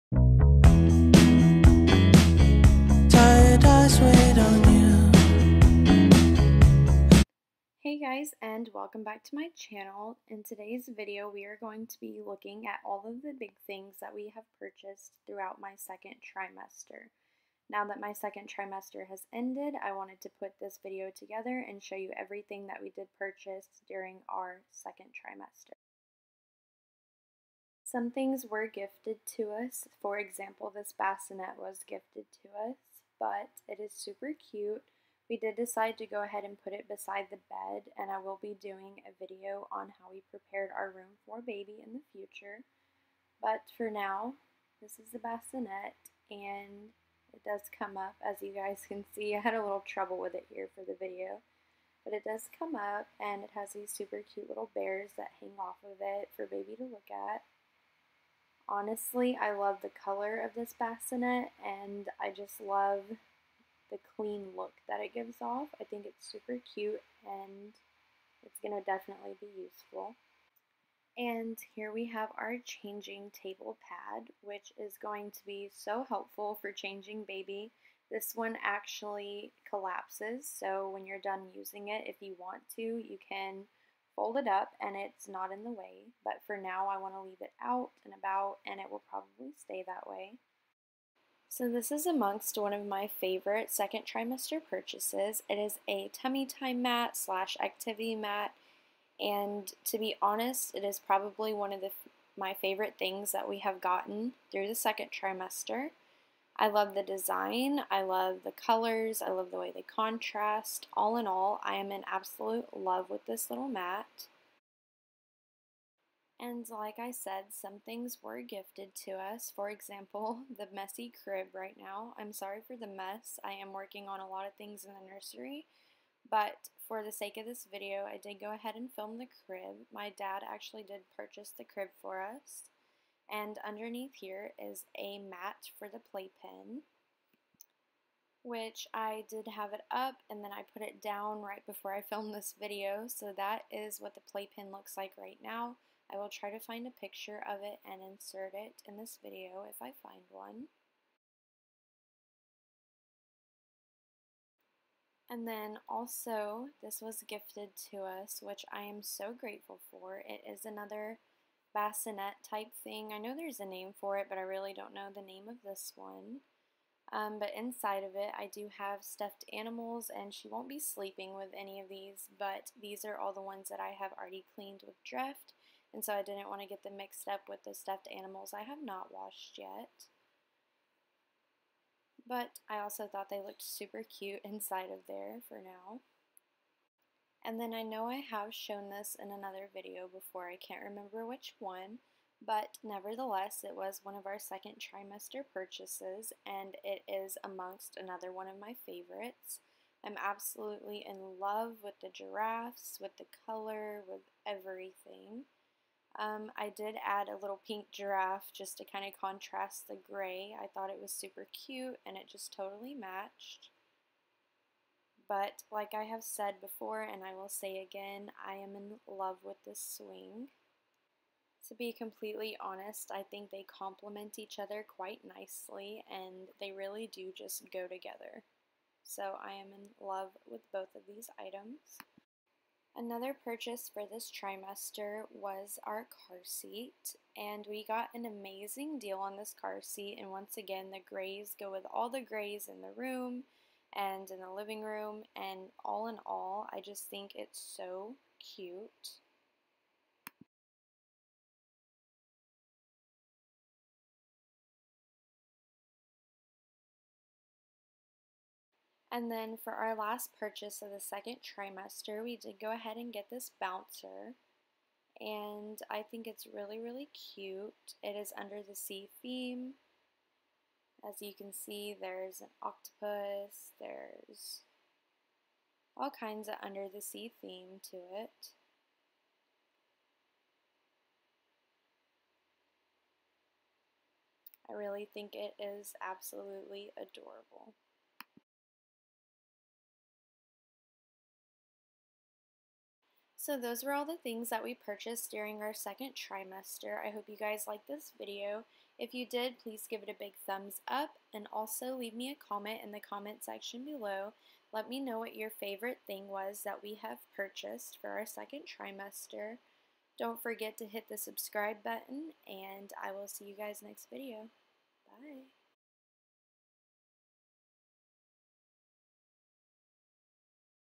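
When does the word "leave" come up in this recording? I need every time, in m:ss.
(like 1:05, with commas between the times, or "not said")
1:27, 5:01.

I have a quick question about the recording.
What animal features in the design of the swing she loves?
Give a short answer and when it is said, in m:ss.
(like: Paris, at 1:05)
Giraffes, at 3:22.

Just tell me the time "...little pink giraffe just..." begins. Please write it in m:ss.
3:27.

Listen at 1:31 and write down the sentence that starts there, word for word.
So this is amongst one of my favorite second trimester purchases.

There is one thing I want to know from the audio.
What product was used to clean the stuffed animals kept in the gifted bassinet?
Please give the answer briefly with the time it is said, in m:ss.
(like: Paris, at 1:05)
Dreft, at 2:55.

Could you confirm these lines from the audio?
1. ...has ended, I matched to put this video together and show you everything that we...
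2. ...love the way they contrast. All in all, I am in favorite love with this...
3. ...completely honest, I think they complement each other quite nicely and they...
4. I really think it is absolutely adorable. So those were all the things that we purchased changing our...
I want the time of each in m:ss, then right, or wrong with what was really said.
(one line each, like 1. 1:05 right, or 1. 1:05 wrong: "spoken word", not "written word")
1. 0:19 wrong: "wanted", not "matched"
2. 1:49 wrong: "absolute", not "favorite"
3. 3:41 right
4. 4:44 wrong: "during", not "changing".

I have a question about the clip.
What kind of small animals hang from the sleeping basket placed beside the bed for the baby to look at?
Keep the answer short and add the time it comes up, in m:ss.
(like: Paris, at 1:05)
Bears, at 0:54.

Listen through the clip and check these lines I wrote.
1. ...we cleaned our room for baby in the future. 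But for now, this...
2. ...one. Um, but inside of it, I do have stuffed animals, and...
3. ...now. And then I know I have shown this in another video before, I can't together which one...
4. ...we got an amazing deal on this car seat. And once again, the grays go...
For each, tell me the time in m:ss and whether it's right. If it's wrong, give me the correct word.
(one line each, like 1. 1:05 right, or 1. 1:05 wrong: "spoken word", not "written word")
1. 0:40 wrong: "prepared", not "cleaned"
2. 2:45 right
3. 3:05 wrong: "remember", not "together"
4. 3:57 right.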